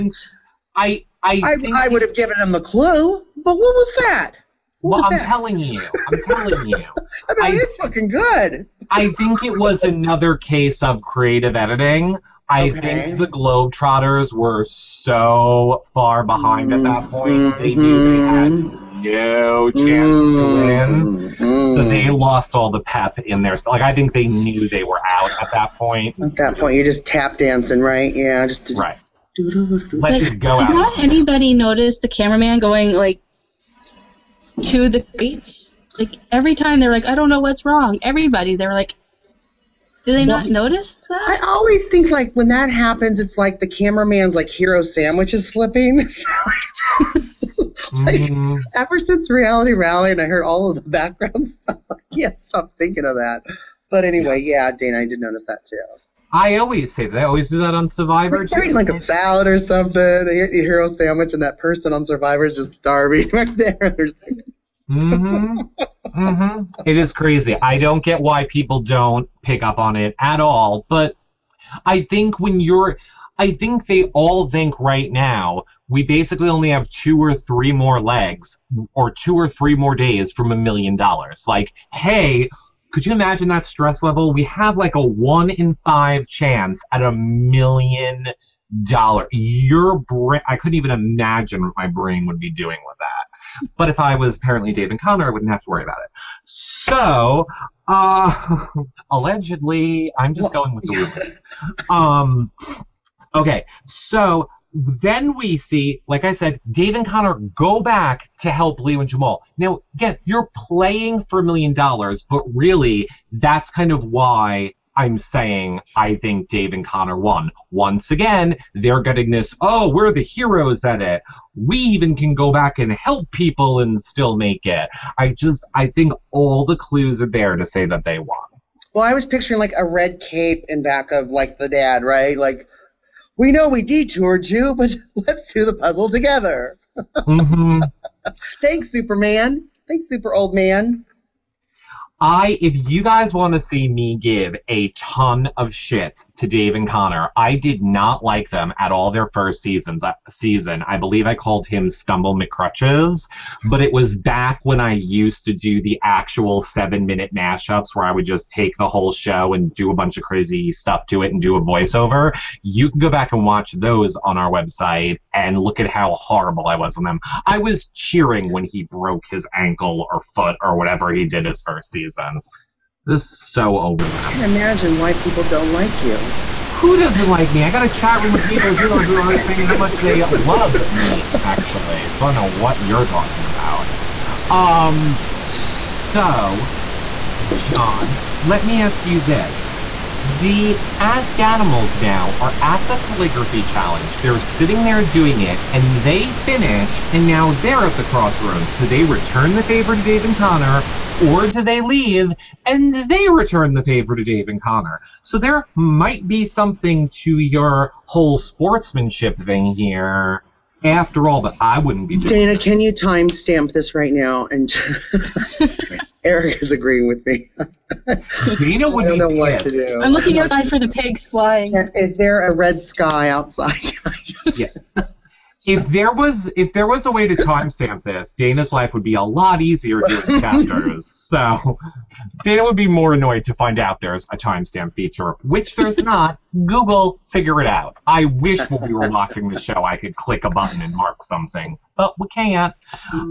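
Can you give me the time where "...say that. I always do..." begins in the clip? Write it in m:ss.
0:56.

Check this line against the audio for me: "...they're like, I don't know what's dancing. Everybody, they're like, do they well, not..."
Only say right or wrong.
wrong.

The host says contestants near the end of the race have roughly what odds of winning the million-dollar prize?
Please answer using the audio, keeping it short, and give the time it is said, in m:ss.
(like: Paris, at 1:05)
one in five, at 1:25.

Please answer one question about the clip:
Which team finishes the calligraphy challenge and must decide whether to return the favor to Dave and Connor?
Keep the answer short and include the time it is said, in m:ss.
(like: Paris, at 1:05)
the Afghanimals, at 3:10.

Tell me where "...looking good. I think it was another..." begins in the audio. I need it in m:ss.
0:07.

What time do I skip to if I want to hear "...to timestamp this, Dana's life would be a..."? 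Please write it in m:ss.
3:47.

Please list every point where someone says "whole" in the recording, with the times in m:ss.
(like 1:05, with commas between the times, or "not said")
2:38, 3:28.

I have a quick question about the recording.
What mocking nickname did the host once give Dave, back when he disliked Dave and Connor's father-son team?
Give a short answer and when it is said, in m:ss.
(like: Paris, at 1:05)
Stumble McCrutches, at 2:31.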